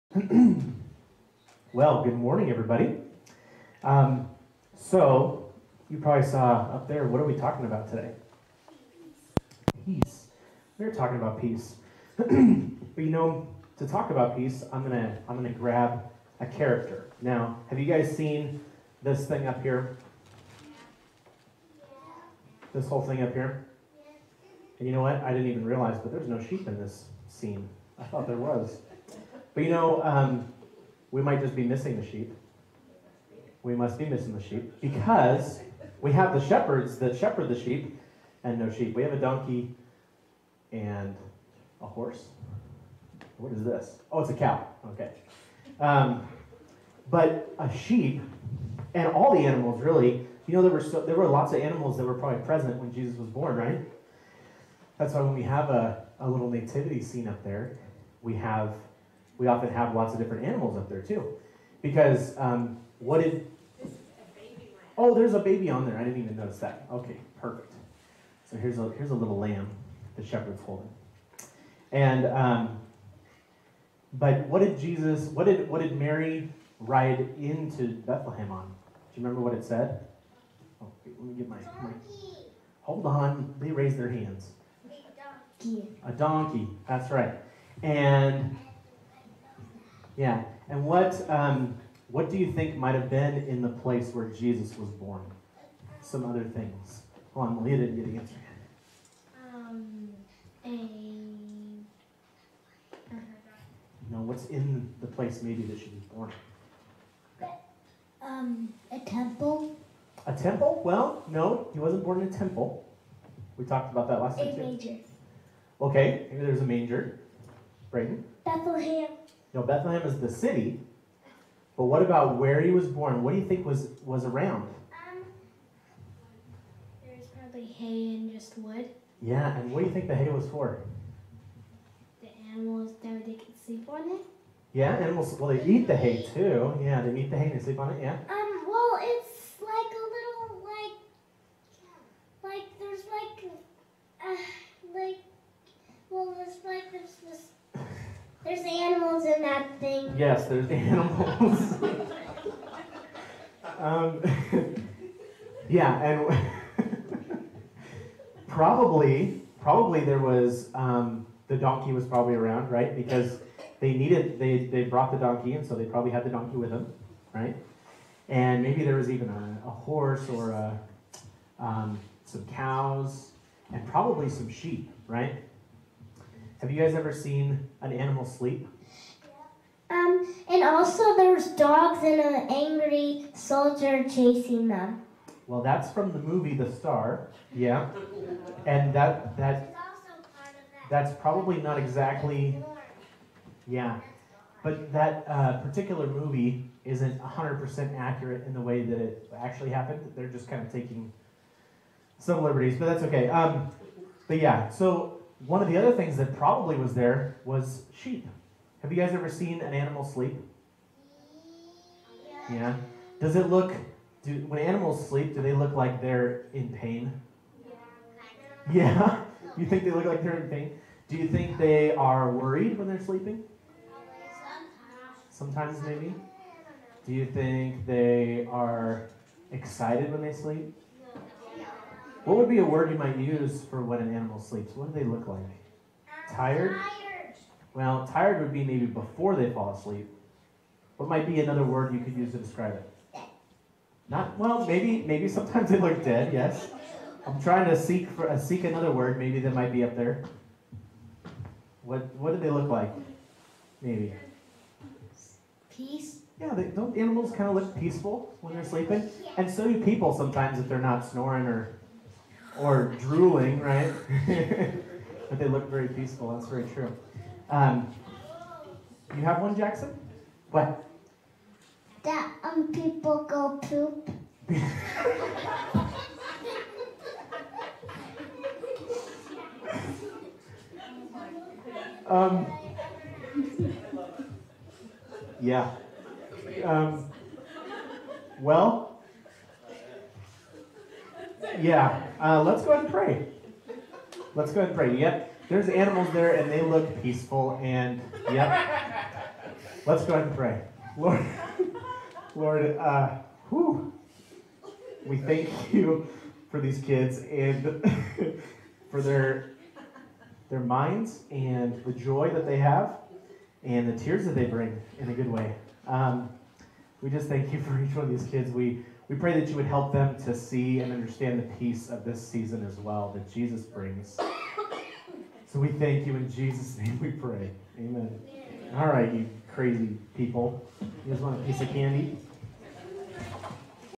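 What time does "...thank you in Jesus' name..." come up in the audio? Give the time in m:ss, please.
5:25.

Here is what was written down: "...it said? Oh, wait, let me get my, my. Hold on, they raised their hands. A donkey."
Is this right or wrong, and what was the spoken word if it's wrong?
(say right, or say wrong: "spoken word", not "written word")
right.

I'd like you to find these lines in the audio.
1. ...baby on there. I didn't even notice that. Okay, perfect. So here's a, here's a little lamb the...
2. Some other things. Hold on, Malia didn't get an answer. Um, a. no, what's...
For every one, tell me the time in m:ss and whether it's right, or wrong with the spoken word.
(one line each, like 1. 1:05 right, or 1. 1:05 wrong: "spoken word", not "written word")
1. 1:05 right
2. 1:36 right.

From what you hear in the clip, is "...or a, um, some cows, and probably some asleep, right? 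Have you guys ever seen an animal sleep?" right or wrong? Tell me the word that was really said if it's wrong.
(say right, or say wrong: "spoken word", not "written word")
wrong: "sheep", not "asleep".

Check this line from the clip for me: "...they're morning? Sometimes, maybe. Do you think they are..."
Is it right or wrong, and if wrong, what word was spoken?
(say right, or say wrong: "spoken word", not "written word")
wrong: "sleeping", not "morning".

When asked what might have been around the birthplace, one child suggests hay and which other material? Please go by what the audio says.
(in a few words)
Wood.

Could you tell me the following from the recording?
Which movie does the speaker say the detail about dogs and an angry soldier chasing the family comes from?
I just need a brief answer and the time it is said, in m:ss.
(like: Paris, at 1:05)
The Star, at 3:06.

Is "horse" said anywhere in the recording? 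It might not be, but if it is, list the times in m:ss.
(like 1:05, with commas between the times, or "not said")
0:41, 2:49.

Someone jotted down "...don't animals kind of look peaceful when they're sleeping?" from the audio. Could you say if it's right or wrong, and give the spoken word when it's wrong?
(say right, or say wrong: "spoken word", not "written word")
right.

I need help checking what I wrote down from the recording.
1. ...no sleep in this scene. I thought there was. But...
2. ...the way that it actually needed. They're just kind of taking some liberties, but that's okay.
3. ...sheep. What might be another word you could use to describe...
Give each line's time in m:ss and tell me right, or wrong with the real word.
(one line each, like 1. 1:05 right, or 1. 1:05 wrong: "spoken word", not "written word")
1. 0:26 wrong: "sheep", not "sleep"
2. 3:18 wrong: "happened", not "needed"
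3. 3:59 wrong: "asleep", not "sheep".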